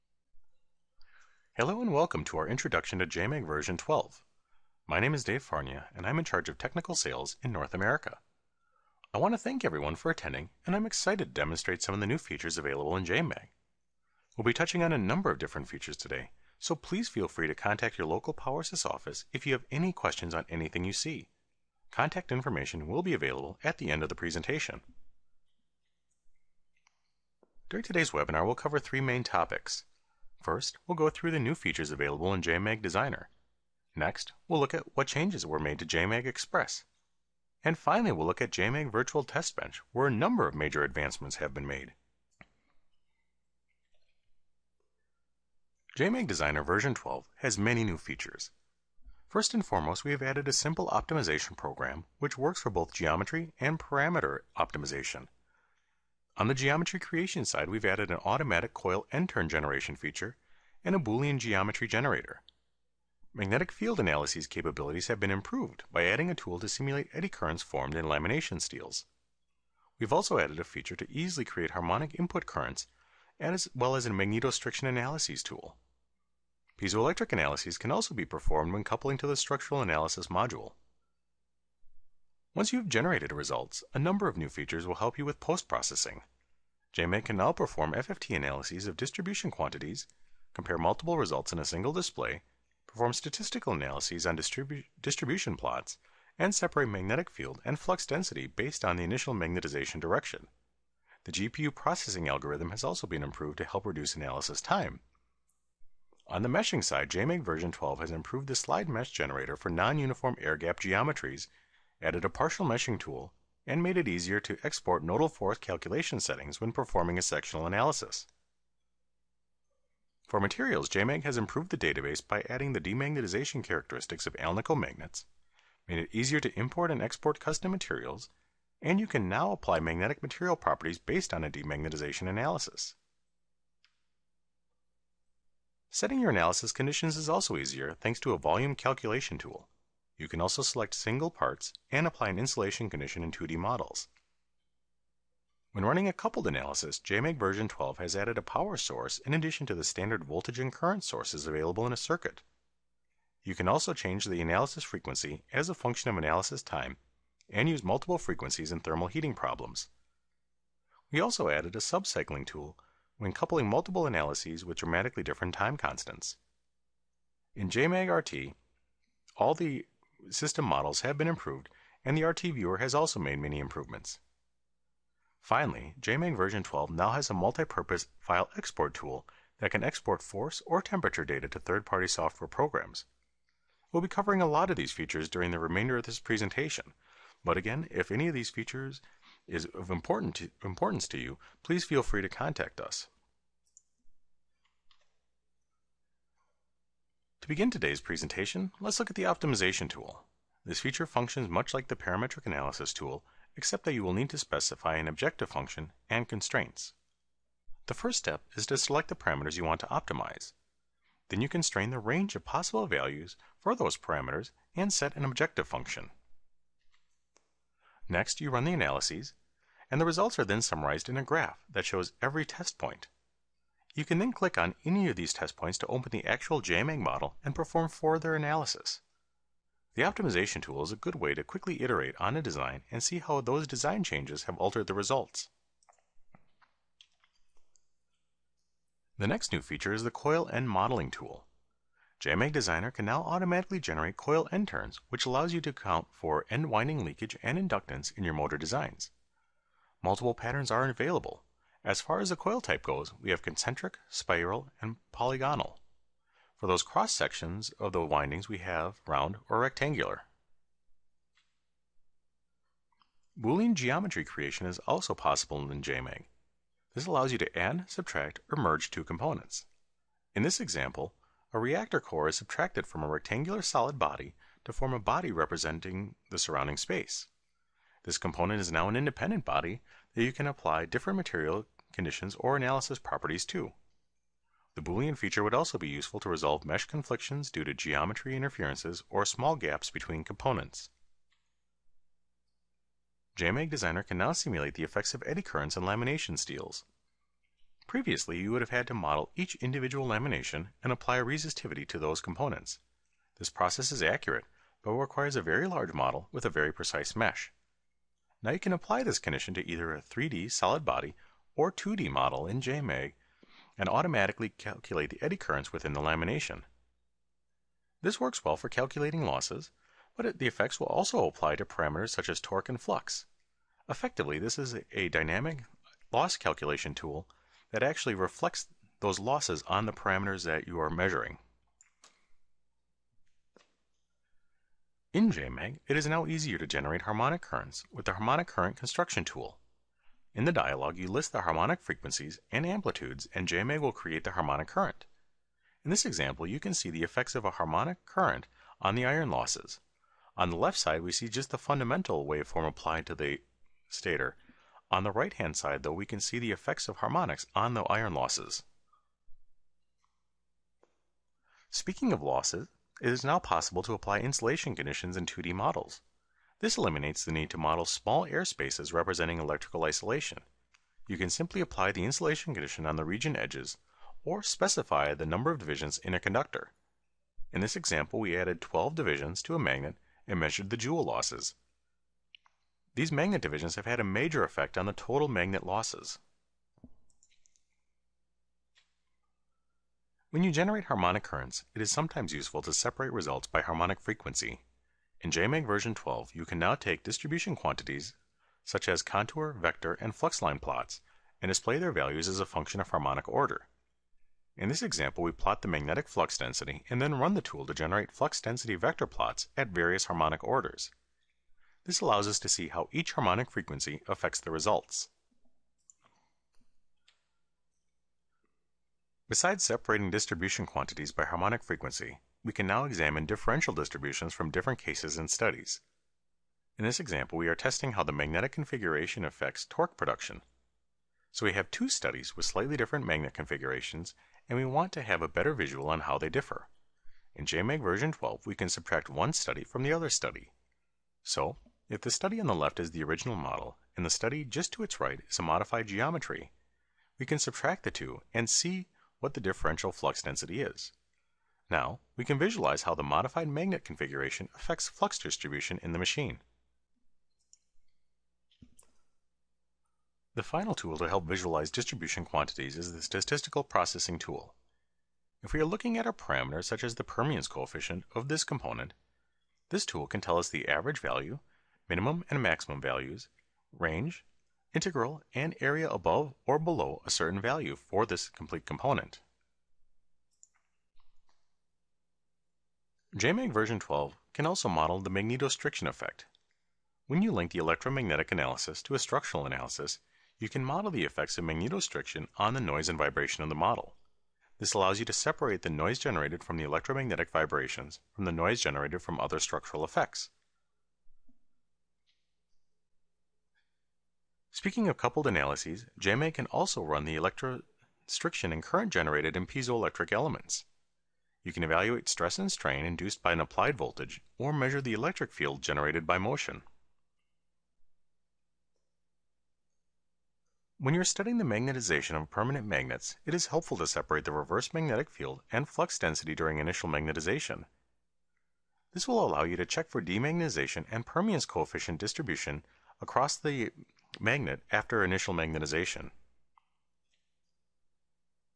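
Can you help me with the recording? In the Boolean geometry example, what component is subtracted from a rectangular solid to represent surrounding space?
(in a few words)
reactor core.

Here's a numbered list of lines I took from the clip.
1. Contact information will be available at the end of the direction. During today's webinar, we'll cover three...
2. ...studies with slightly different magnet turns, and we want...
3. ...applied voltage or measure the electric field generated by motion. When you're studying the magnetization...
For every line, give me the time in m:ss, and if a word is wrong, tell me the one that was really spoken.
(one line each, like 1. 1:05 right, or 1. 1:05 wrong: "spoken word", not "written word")
1. 0:21 wrong: "presentation", not "direction"
2. 7:11 wrong: "configurations", not "turns"
3. 8:33 right.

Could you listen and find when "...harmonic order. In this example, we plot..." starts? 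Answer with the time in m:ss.
6:42.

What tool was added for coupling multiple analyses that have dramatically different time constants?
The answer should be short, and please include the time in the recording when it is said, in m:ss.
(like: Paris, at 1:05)
subcycling tool, at 2:41.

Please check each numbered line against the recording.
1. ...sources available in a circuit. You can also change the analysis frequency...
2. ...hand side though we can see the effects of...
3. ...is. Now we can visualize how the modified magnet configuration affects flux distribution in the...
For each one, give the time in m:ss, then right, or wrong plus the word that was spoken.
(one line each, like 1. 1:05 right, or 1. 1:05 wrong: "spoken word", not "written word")
1. 2:31 right
2. 5:55 right
3. 7:30 right.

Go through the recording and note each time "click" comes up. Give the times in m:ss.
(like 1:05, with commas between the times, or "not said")
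3:44.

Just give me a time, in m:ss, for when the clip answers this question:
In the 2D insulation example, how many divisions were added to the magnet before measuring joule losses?
6:18.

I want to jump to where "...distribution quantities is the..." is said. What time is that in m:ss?
7:41.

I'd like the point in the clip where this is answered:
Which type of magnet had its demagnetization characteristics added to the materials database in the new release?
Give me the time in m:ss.
2:04.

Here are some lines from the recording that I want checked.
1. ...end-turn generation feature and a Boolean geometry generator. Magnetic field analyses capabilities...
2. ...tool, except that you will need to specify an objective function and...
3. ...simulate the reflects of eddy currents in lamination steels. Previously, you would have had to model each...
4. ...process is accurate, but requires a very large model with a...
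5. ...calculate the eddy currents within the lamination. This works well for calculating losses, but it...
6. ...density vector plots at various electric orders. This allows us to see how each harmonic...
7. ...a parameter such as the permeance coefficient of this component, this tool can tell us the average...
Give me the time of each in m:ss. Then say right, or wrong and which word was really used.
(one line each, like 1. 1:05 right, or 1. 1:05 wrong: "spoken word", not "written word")
1. 0:59 right
2. 3:22 right
3. 4:54 wrong: "effects", not "reflects"
4. 5:03 right
5. 5:14 right
6. 6:48 wrong: "harmonic", not "electric"
7. 7:46 right.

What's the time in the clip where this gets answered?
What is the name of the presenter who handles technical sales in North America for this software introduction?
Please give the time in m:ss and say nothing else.
0:05.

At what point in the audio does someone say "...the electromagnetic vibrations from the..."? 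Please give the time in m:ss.
8:16.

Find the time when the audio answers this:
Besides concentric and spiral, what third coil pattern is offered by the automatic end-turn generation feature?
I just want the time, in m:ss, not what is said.
4:15.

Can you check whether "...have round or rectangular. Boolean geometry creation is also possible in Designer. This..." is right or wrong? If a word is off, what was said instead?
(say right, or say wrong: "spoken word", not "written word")
wrong: "JMAG", not "Designer".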